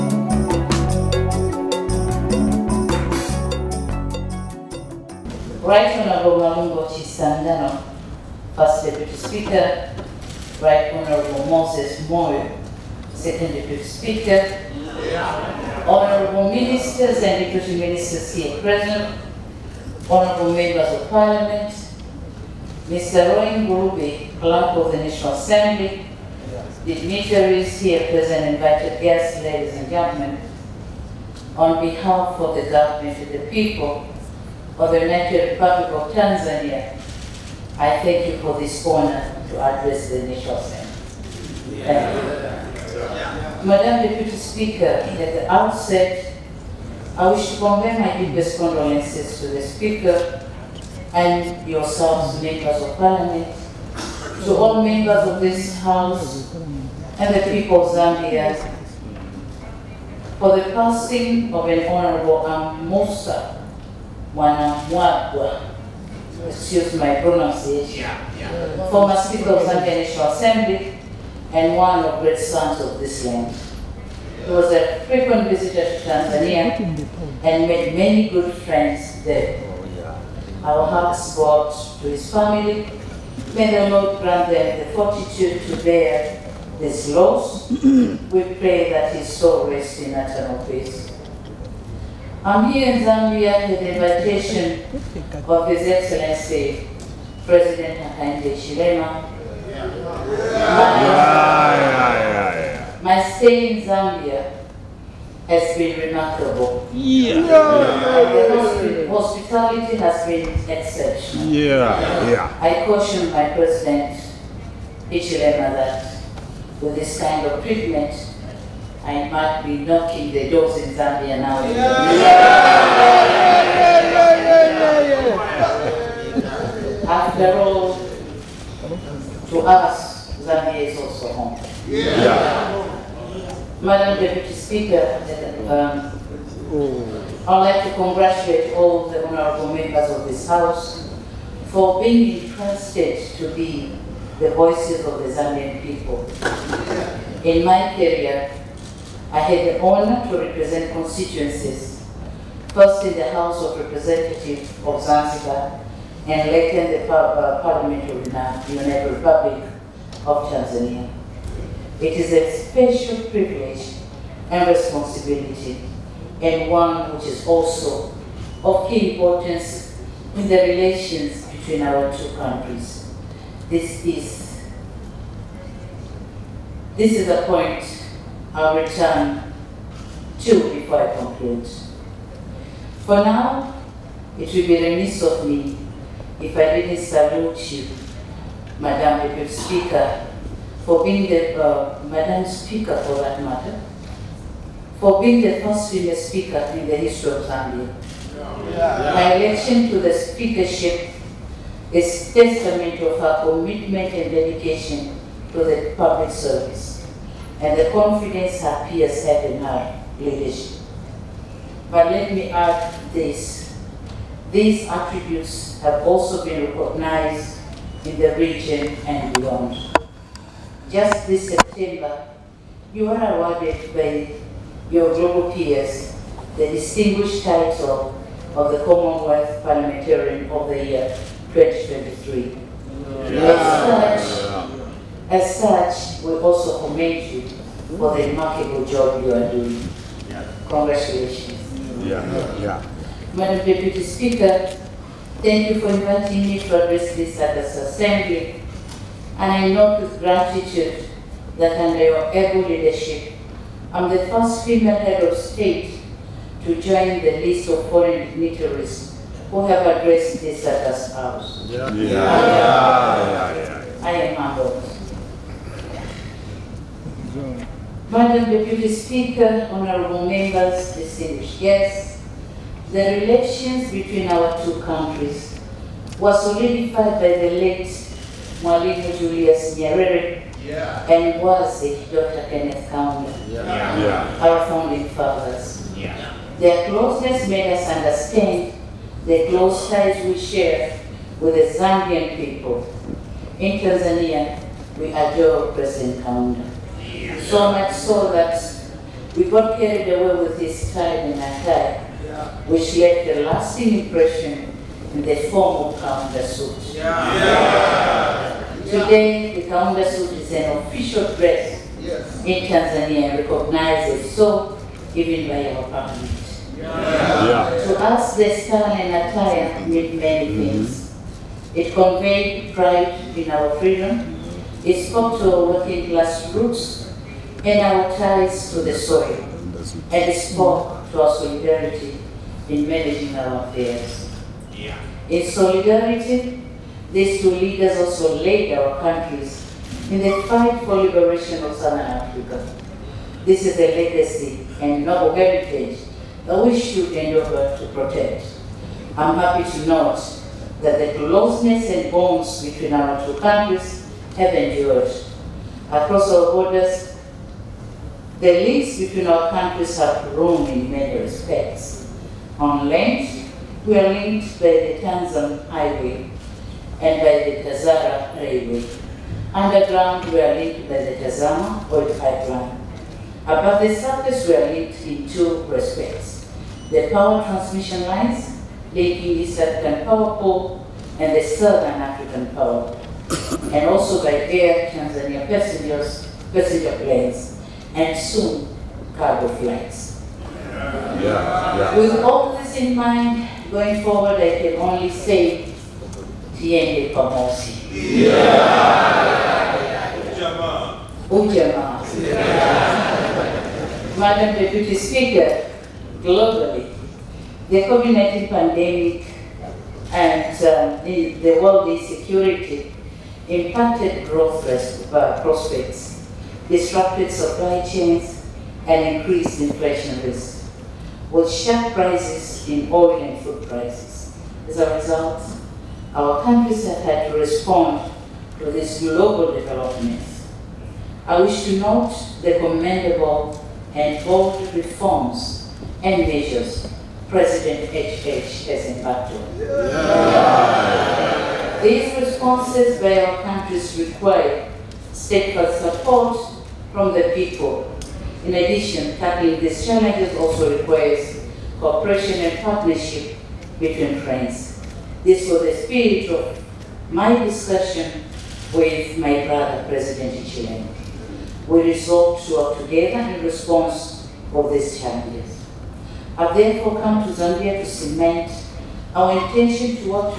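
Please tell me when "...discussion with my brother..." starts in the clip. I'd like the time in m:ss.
7:37.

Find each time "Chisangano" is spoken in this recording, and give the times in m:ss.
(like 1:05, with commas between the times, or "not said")
0:06.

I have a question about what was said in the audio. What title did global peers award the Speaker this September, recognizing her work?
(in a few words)
Commonwealth Parliamentarian of the Year.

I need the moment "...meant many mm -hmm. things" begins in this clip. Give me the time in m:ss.
5:19.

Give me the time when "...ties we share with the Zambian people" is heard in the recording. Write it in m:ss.
4:49.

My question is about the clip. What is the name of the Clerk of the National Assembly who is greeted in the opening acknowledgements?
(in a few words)
Roy Ngulube.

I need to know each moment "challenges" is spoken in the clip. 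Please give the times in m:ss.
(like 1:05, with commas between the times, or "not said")
7:29, 7:44.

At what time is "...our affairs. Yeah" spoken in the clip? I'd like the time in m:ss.
5:33.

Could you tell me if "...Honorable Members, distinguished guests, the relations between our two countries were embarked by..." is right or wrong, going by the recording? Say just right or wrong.
wrong.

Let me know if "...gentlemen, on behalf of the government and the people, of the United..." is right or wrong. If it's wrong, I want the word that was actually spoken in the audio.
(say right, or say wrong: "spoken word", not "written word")
right.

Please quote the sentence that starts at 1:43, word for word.
My, my stay in Zambia has been remarkable.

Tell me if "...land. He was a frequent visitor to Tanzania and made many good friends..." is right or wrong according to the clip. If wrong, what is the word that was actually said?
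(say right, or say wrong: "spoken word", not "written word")
right.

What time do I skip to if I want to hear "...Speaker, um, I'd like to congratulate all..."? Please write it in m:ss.
2:14.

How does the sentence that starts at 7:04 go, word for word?
As a result, our countries have had to respond to these global developments.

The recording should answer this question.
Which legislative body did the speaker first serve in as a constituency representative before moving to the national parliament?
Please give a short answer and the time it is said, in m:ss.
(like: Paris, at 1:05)
House of Representatives of Zanzibar, at 2:33.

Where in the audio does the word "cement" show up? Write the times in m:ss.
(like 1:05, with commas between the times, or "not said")
7:47.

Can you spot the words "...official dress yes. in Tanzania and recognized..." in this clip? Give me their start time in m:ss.
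5:10.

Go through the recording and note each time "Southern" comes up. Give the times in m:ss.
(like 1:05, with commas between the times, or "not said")
5:41, 6:21.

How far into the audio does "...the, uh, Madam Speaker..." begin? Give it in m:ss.
3:11.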